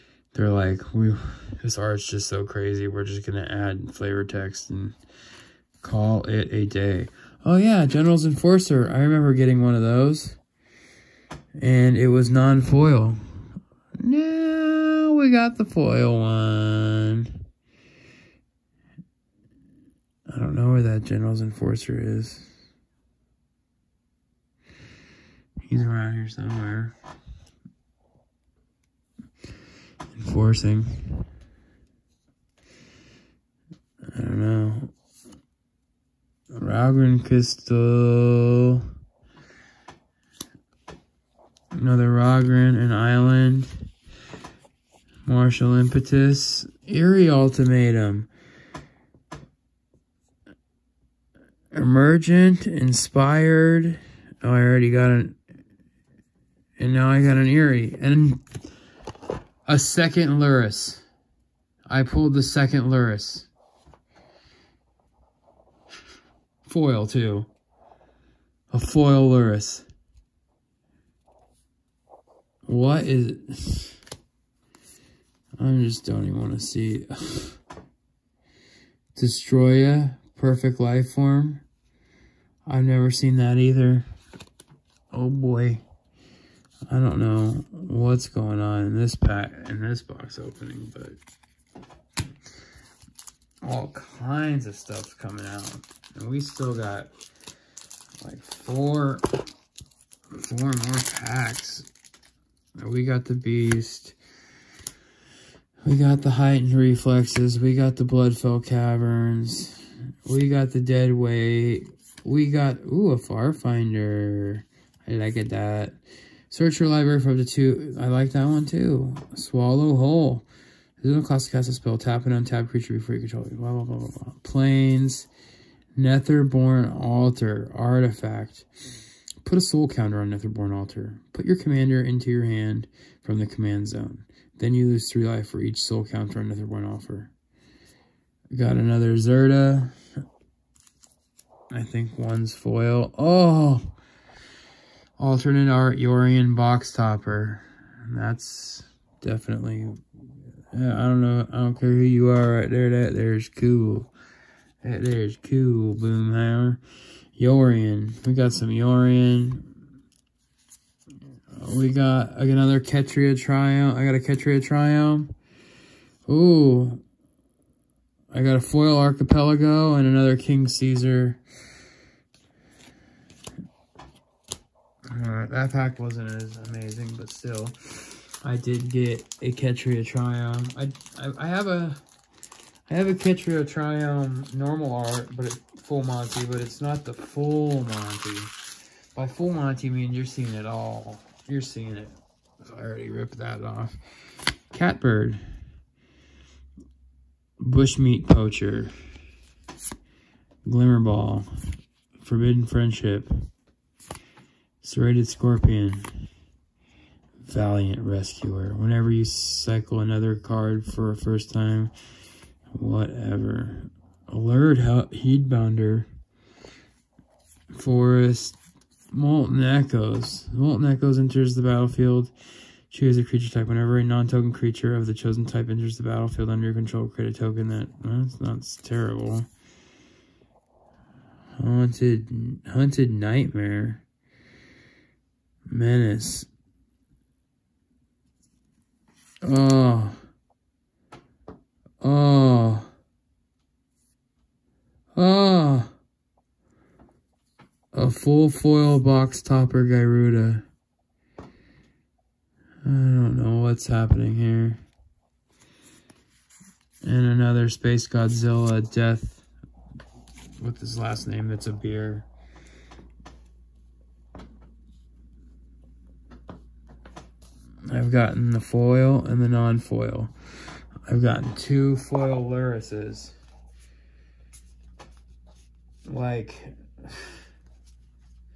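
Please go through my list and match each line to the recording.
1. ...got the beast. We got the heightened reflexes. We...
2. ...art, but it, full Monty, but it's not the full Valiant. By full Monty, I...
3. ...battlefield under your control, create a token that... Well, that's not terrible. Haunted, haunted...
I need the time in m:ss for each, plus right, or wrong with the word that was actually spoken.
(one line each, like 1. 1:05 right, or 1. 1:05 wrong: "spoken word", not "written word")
1. 1:43 right
2. 3:04 wrong: "Monty", not "Valiant"
3. 3:46 right.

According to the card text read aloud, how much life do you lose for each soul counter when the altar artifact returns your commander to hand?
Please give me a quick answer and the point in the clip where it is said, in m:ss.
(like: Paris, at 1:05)
3, at 2:15.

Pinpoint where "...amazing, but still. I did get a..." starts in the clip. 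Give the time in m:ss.
2:56.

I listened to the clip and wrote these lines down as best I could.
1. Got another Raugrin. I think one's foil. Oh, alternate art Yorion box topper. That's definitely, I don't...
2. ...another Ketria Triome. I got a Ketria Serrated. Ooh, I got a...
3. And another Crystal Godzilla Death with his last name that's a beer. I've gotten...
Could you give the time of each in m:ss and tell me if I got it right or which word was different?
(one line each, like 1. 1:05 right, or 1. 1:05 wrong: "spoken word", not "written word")
1. 2:18 wrong: "Zerda", not "Raugrin"
2. 2:42 wrong: "Triome", not "Serrated"
3. 4:17 wrong: "Space", not "Crystal".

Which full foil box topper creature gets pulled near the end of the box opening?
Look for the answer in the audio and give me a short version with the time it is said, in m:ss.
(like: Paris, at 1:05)
Gyruda, at 4:09.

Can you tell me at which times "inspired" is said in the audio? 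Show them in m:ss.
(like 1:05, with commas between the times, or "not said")
0:52.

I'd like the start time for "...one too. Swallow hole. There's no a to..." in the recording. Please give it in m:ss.
1:58.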